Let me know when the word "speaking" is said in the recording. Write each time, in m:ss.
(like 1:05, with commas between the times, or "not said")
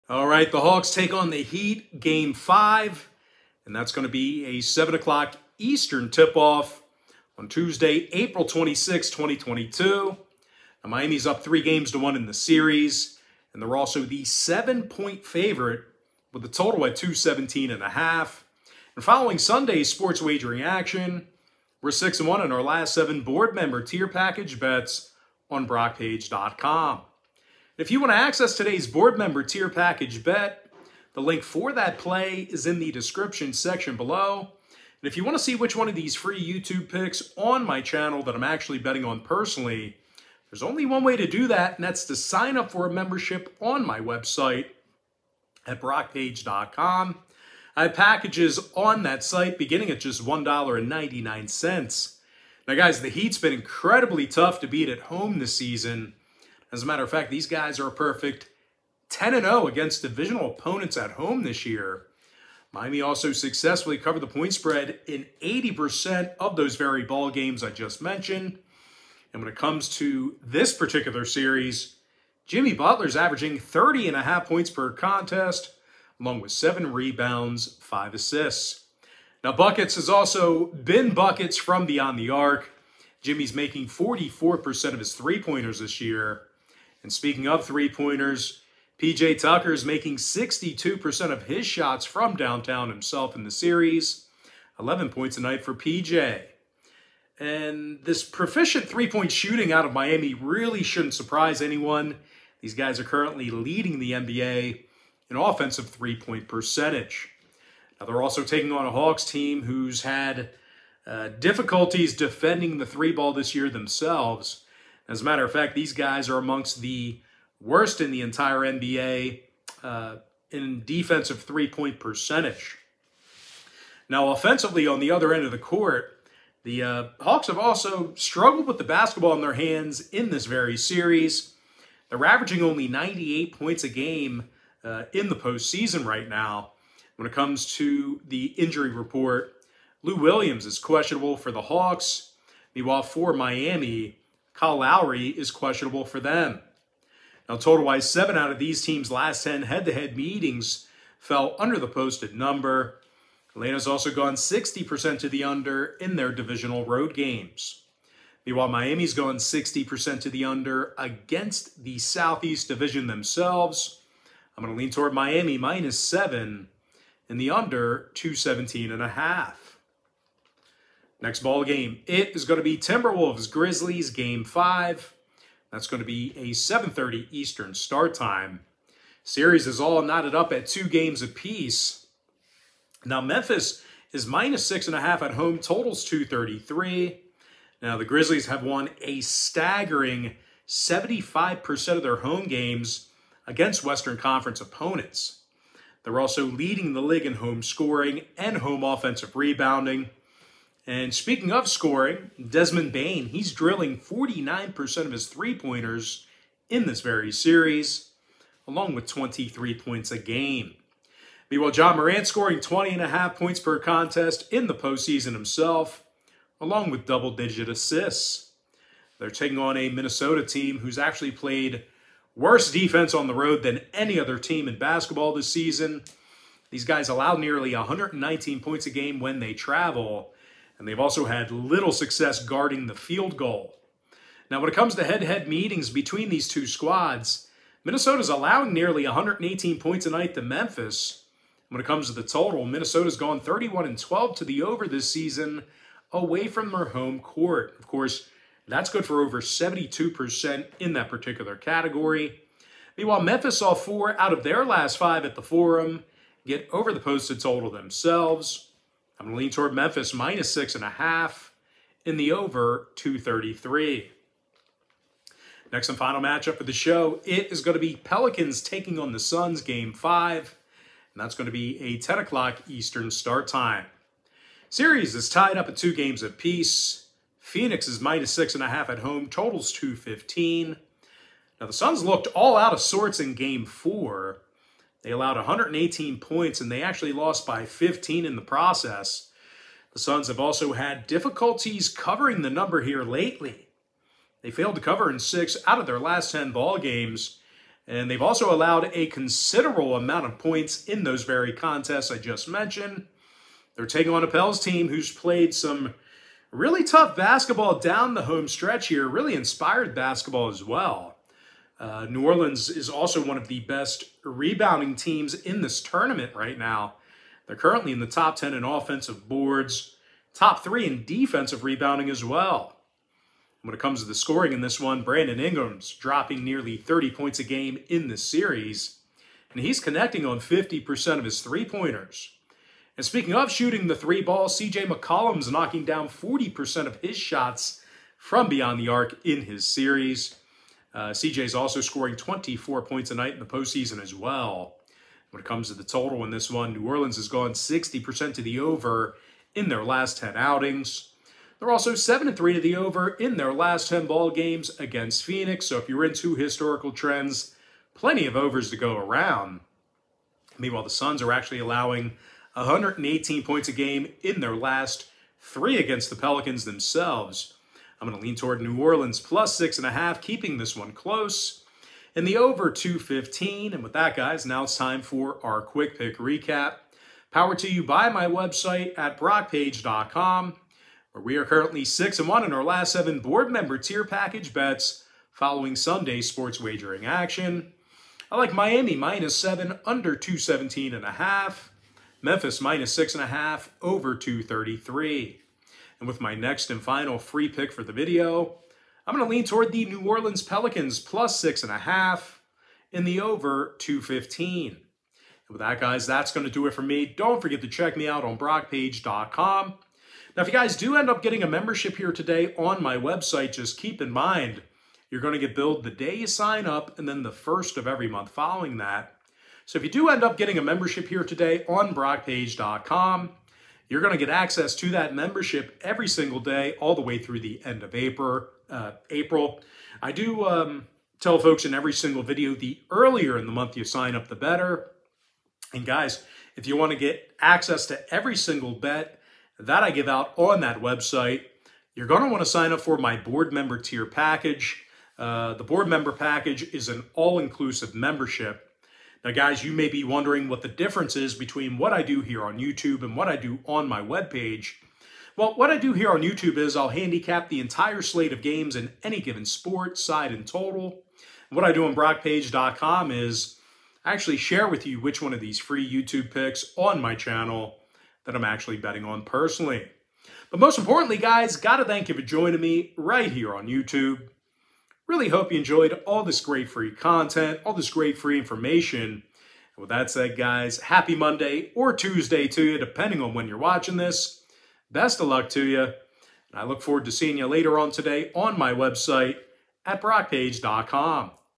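1:27, 3:21, 5:33.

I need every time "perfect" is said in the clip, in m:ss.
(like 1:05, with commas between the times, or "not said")
0:57.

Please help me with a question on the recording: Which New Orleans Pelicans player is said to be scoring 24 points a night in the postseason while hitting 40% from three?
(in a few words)
CJ McCollum.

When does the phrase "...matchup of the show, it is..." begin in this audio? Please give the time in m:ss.
4:26.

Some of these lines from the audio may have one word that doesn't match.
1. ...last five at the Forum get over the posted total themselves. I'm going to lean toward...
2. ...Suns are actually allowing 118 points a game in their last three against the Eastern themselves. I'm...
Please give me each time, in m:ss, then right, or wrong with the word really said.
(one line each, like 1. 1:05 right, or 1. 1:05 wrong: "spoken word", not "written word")
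1. 4:14 right
2. 6:00 wrong: "Pelicans", not "Eastern".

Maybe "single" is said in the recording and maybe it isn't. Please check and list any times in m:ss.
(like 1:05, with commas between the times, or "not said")
7:06, 7:11, 7:18.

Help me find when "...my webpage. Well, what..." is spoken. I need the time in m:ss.
7:33.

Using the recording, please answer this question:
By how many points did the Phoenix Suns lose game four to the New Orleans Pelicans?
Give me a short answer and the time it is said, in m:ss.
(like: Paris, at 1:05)
15, at 4:47.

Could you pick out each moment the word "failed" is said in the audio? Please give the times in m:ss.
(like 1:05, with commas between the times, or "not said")
4:54.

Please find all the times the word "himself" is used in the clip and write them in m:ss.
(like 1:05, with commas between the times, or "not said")
1:32, 3:35.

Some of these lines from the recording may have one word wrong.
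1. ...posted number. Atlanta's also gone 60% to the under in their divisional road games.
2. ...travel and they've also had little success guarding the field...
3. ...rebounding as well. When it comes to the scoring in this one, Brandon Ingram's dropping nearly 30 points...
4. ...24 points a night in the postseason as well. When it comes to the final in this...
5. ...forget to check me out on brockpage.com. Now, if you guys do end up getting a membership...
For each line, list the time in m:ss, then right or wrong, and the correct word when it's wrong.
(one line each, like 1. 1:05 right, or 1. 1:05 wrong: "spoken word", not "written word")
1. 2:31 right
2. 3:49 right
3. 5:21 right
4. 5:42 wrong: "total", not "final"
5. 6:47 right.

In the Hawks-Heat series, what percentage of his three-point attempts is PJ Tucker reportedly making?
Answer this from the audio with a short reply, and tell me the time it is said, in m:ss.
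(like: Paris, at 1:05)
62%, at 1:30.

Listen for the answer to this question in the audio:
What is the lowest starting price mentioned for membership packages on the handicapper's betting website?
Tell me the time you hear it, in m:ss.
0:50.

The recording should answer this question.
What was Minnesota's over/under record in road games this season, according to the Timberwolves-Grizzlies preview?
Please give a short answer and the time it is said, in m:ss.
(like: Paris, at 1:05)
31-12, at 4:03.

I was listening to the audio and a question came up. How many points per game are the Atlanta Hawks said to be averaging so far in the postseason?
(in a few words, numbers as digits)
98.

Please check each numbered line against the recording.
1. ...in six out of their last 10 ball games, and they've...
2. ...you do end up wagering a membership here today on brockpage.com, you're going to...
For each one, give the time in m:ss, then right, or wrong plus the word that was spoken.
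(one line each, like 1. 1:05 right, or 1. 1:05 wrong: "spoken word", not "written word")
1. 4:55 right
2. 6:59 wrong: "getting", not "wagering".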